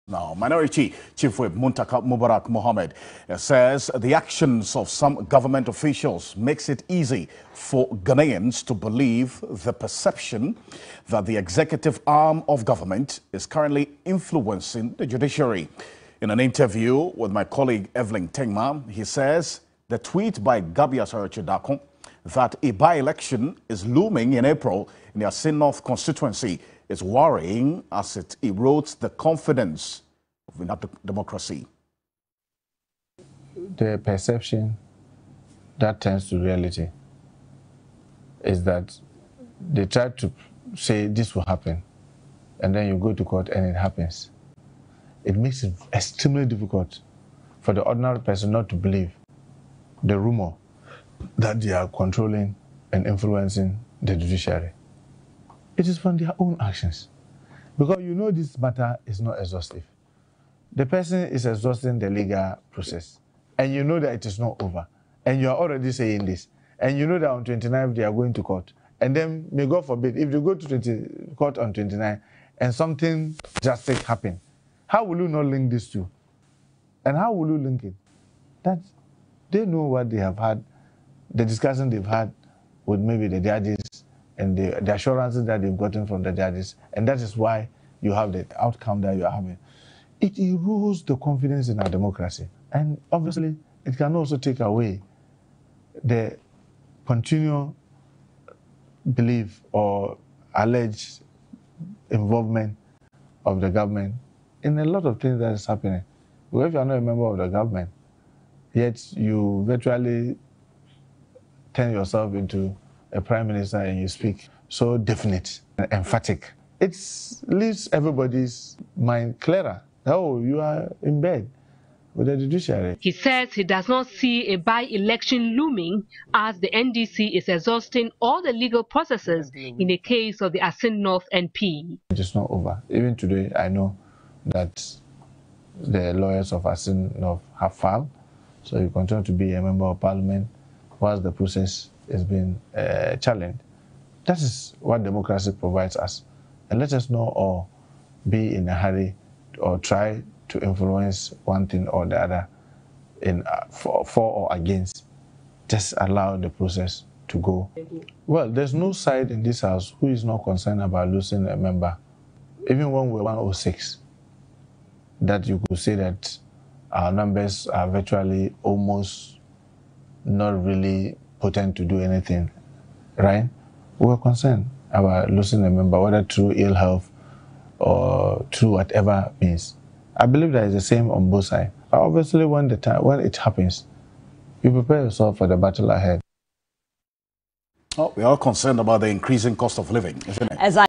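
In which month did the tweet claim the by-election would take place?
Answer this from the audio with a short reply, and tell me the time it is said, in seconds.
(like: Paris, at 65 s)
April, at 24 s.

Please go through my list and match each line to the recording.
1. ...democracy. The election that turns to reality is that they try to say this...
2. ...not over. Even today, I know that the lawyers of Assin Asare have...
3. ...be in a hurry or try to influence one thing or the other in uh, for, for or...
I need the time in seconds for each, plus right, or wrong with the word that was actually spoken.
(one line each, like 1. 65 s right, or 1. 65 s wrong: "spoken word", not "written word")
1. 31 s wrong: "perception", not "election"
2. 132 s wrong: "North", not "Asare"
3. 148 s right.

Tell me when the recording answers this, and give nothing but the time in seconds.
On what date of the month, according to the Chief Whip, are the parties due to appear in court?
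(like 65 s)
67 s.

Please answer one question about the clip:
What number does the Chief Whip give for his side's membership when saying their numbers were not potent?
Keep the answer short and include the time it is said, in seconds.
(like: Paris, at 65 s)
106, at 163 s.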